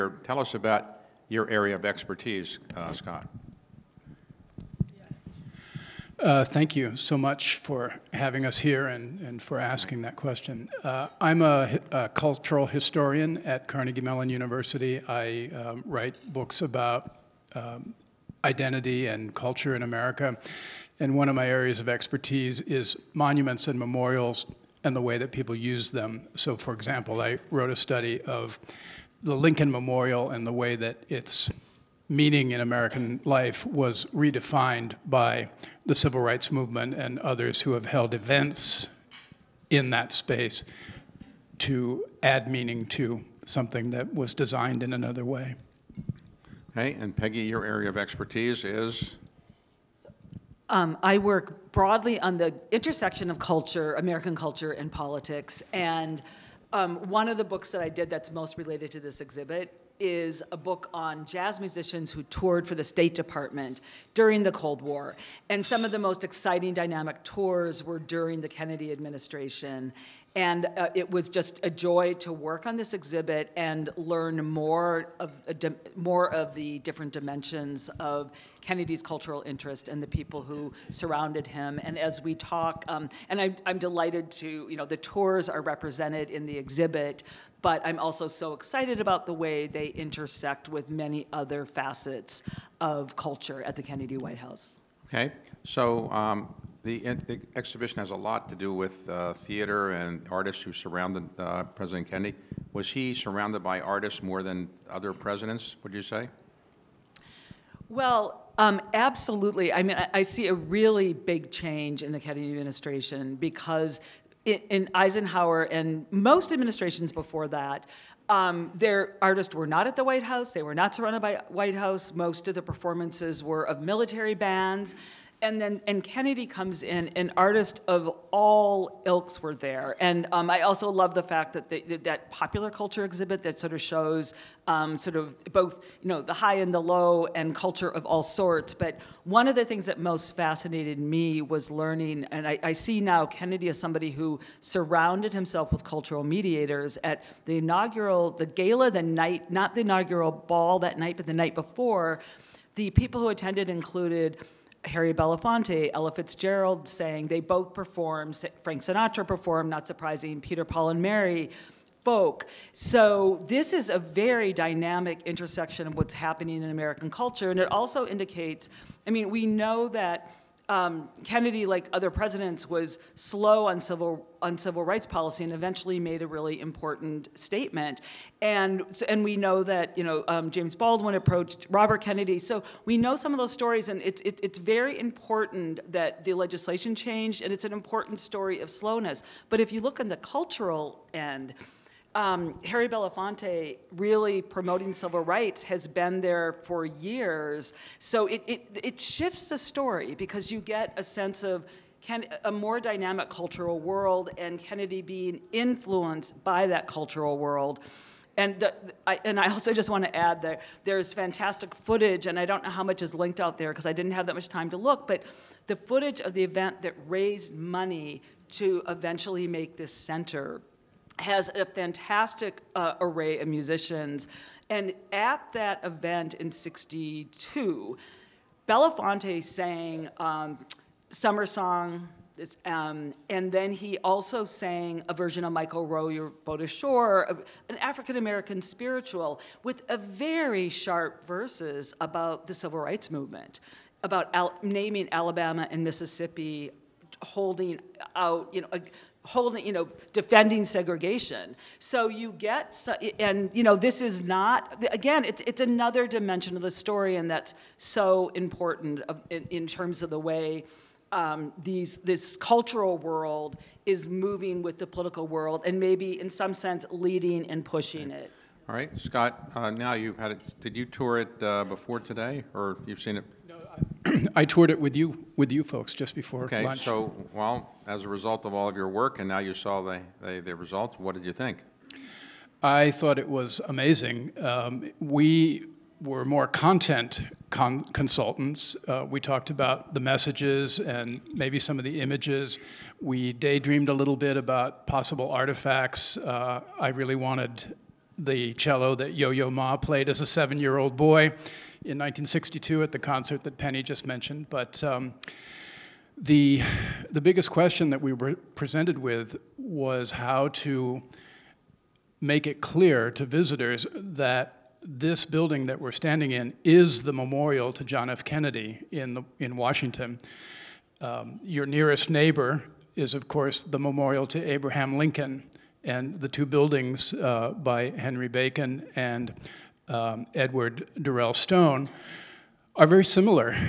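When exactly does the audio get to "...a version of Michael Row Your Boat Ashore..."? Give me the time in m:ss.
3:55.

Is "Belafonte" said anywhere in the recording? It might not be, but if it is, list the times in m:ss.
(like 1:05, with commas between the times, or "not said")
2:35, 3:12, 3:48.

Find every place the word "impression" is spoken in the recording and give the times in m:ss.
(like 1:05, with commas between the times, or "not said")
not said.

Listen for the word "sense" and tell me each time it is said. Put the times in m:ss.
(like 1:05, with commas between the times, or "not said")
3:21, 4:26.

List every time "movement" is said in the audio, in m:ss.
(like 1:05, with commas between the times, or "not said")
0:36, 4:03.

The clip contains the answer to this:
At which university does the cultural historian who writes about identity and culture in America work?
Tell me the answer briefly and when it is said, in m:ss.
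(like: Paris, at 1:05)
Carnegie Mellon University, at 0:13.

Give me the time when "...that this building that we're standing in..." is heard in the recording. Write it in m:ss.
5:13.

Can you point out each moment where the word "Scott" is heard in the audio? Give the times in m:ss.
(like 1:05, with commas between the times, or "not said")
0:02, 4:28.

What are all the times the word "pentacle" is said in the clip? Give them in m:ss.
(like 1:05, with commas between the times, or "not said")
not said.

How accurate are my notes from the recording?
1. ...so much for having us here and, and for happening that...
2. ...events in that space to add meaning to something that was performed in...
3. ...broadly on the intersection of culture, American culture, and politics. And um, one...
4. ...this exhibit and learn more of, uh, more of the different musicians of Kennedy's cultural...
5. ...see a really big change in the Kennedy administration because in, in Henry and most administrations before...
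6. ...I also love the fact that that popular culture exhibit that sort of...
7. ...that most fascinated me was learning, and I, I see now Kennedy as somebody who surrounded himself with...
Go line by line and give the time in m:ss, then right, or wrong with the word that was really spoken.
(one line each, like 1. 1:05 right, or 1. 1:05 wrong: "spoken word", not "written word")
1. 0:06 wrong: "asking", not "happening"
2. 0:38 wrong: "designed", not "performed"
3. 0:51 right
4. 1:12 wrong: "dimensions", not "musicians"
5. 1:50 wrong: "Eisenhower", not "Henry"
6. 2:10 right
7. 2:19 right.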